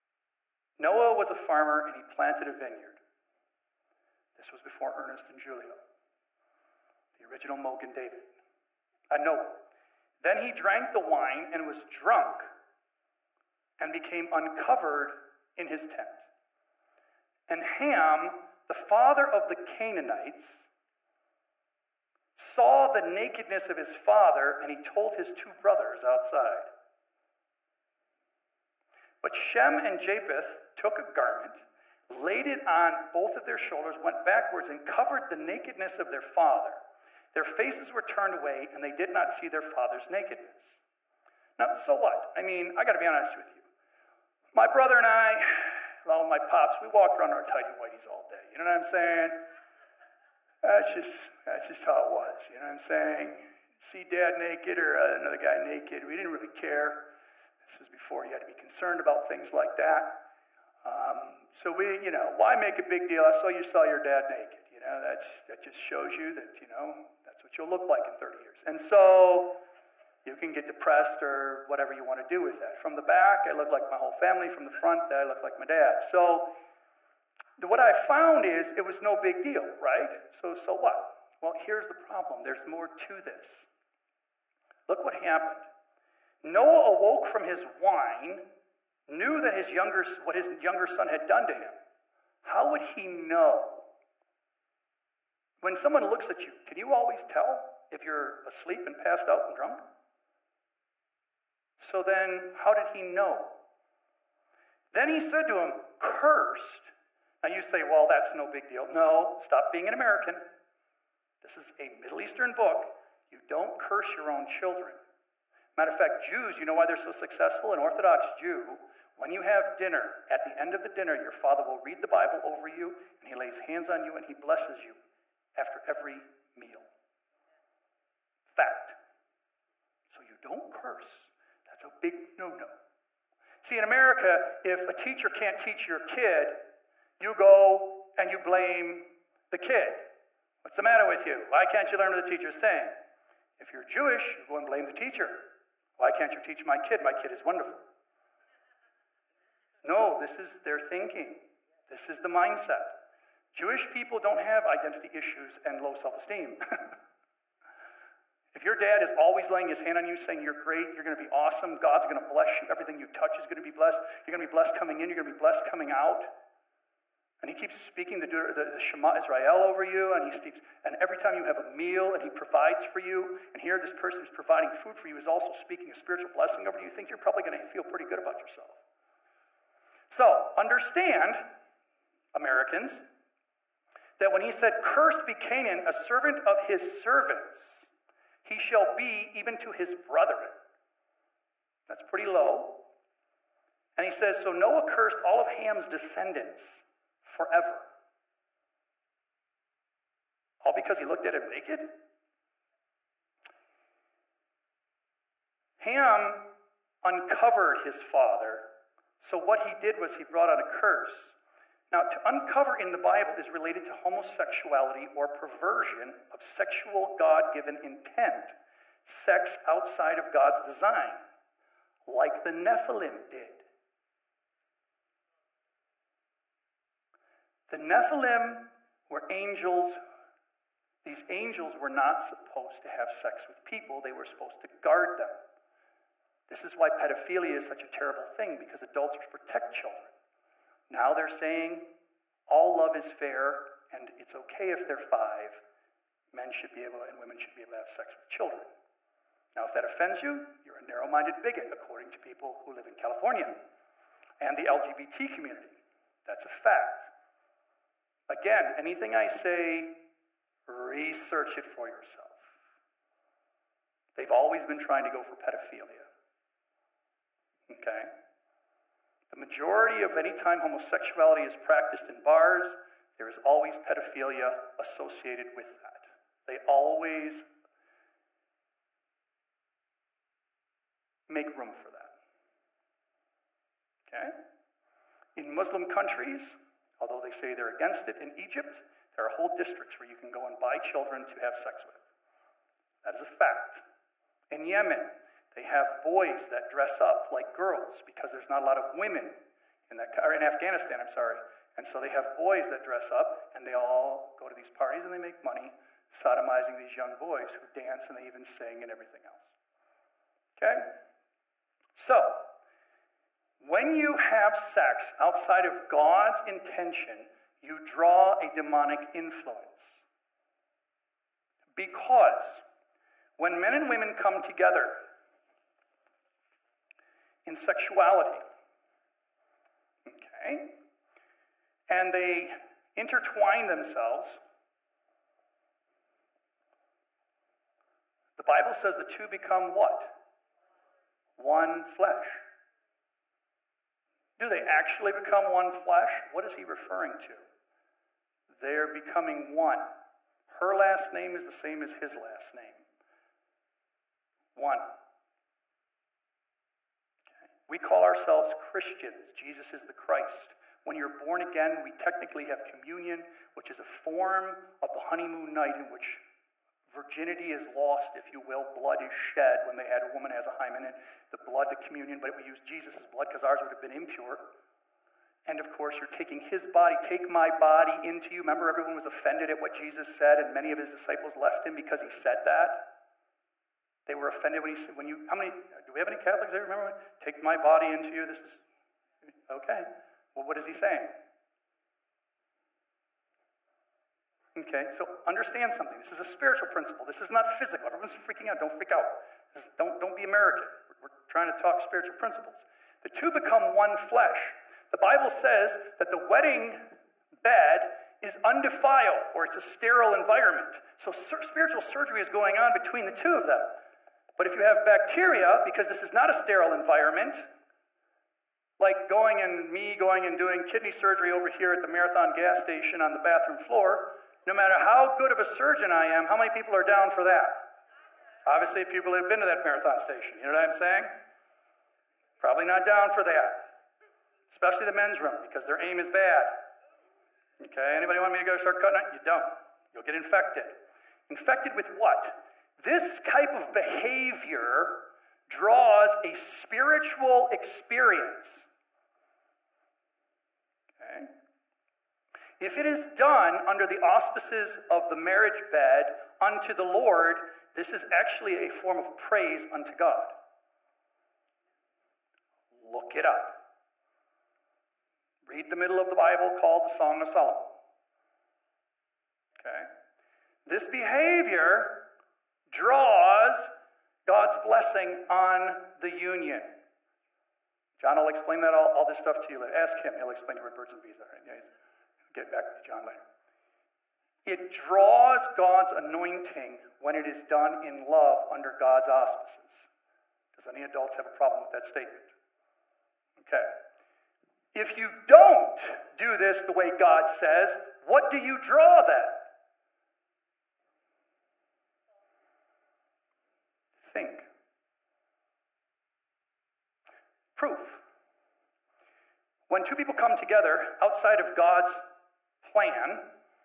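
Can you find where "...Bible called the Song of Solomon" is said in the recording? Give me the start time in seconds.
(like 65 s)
466 s.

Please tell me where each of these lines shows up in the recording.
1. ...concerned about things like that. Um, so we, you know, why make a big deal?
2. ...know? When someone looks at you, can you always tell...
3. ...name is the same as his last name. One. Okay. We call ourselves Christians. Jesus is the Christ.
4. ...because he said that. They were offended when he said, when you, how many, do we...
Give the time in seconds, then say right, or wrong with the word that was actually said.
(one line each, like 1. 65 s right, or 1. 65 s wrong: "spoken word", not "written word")
1. 58 s right
2. 93 s right
3. 351 s right
4. 381 s right.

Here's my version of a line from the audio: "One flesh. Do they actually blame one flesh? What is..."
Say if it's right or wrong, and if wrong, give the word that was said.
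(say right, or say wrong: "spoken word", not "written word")
wrong: "become", not "blame".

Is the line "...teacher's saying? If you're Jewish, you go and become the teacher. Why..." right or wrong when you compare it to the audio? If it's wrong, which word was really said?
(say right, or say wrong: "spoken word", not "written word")
wrong: "blame", not "become".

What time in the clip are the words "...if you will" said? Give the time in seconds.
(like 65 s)
368 s.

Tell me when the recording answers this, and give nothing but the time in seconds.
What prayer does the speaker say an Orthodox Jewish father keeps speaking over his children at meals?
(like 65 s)
168 s.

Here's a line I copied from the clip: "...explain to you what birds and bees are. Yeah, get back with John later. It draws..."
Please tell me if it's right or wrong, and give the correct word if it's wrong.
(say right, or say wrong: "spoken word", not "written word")
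right.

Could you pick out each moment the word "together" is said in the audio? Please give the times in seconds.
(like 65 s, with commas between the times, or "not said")
324 s, 510 s.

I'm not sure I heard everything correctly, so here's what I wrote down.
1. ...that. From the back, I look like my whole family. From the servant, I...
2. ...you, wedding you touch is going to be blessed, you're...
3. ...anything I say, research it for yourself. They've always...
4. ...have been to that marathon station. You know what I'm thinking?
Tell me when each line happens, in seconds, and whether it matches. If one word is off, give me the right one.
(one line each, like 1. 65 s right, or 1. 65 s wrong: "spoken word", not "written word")
1. 72 s wrong: "front", not "servant"
2. 162 s wrong: "everything", not "wedding"
3. 258 s right
4. 429 s wrong: "saying", not "thinking".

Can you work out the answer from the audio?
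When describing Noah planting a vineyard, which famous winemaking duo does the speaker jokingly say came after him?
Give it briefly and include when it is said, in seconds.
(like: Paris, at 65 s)
Ernest and Julio, at 4 s.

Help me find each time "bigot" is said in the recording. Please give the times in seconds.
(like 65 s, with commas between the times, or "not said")
251 s.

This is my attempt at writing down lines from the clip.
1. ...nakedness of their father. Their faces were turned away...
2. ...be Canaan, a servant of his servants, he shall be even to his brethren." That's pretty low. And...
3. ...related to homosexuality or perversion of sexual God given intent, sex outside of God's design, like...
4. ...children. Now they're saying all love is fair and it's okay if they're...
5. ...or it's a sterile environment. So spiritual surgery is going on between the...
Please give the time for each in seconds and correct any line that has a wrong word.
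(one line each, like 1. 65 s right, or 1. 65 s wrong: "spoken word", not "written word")
1. 35 s right
2. 185 s right
3. 213 s right
4. 239 s right
5. 409 s right.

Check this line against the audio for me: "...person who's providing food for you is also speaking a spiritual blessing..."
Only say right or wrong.
right.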